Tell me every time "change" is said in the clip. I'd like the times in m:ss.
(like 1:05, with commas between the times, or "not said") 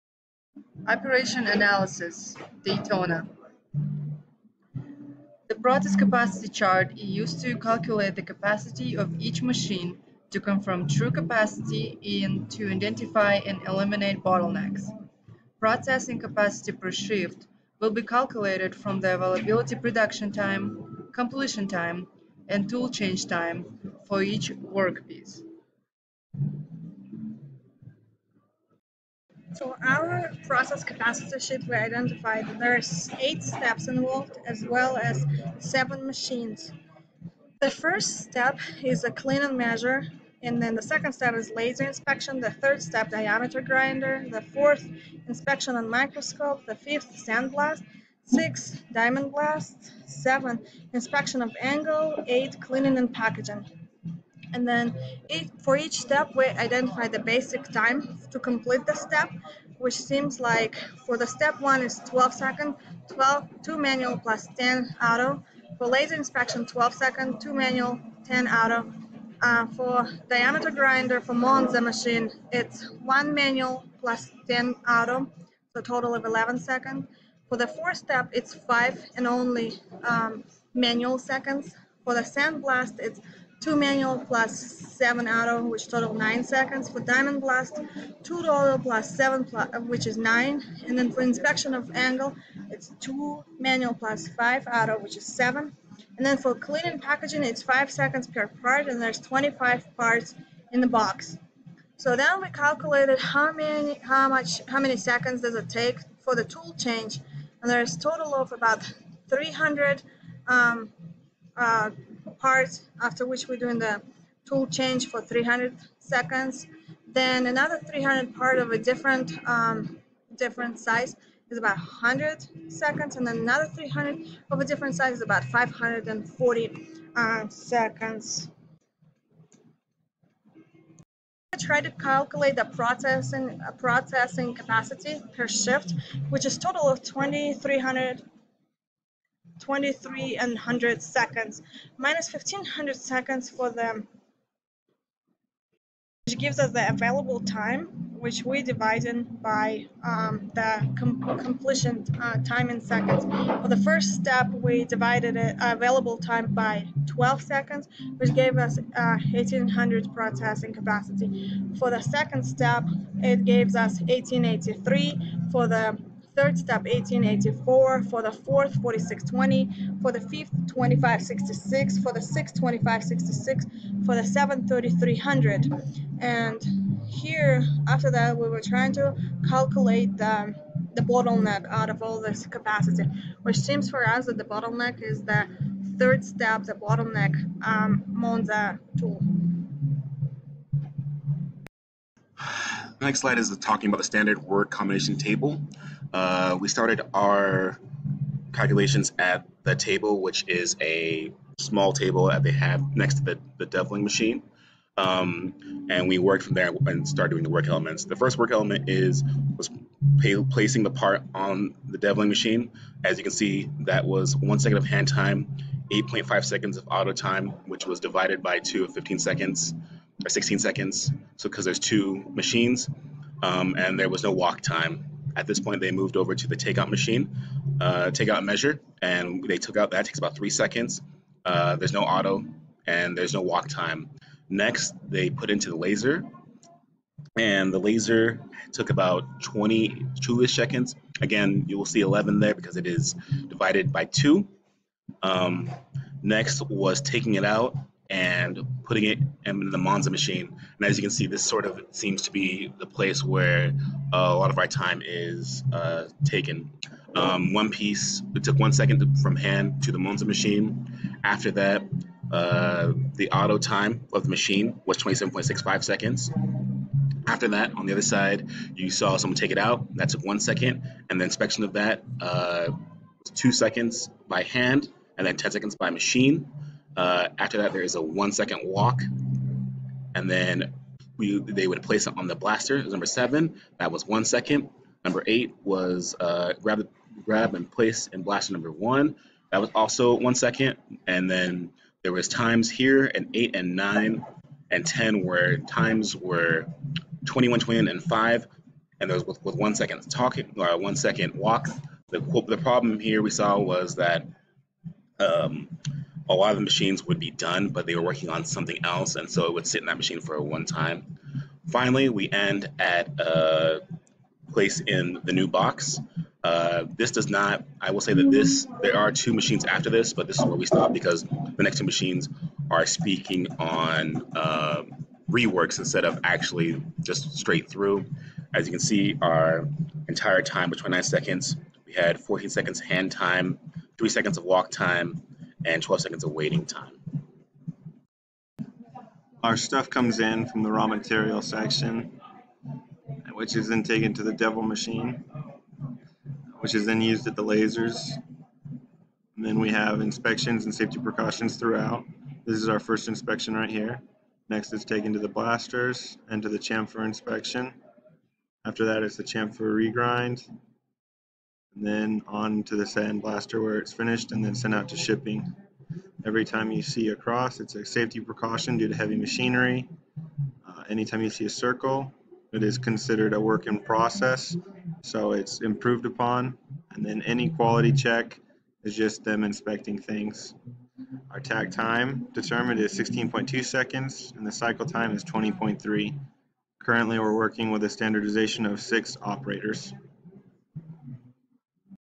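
0:22, 1:46, 1:54.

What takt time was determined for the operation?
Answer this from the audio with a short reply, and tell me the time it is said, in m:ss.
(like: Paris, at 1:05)
16.2 seconds, at 6:22.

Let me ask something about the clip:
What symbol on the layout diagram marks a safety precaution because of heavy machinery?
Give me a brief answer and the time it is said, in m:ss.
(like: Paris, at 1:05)
a cross, at 6:07.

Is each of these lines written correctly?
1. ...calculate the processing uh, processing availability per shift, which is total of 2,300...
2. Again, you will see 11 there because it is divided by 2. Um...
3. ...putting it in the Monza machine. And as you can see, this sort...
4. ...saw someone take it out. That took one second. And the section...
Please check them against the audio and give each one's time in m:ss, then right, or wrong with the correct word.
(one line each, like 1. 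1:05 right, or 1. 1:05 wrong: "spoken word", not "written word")
1. 2:11 wrong: "capacity", not "availability"
2. 4:01 right
3. 4:08 right
4. 4:28 wrong: "inspection", not "section".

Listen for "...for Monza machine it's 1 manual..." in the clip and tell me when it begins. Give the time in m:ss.
1:11.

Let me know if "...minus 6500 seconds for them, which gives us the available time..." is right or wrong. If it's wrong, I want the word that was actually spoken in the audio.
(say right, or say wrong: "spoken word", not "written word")
wrong: "1500", not "6500".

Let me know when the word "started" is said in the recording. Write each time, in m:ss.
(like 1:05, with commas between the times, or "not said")
3:16, 3:27.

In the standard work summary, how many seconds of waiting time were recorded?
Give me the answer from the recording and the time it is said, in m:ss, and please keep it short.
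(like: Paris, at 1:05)
12 seconds, at 5:35.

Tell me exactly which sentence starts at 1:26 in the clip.
For diamond blast, two auto plus seven, plus, which is nine.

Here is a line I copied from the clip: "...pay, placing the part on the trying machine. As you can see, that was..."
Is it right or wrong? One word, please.
wrong.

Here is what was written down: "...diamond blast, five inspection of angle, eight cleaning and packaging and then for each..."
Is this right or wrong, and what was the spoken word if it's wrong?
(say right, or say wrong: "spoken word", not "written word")
wrong: "seven", not "five".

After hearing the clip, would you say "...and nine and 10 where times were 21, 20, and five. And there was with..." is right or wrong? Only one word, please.
right.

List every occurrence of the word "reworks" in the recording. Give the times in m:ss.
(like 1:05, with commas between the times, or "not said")
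5:25.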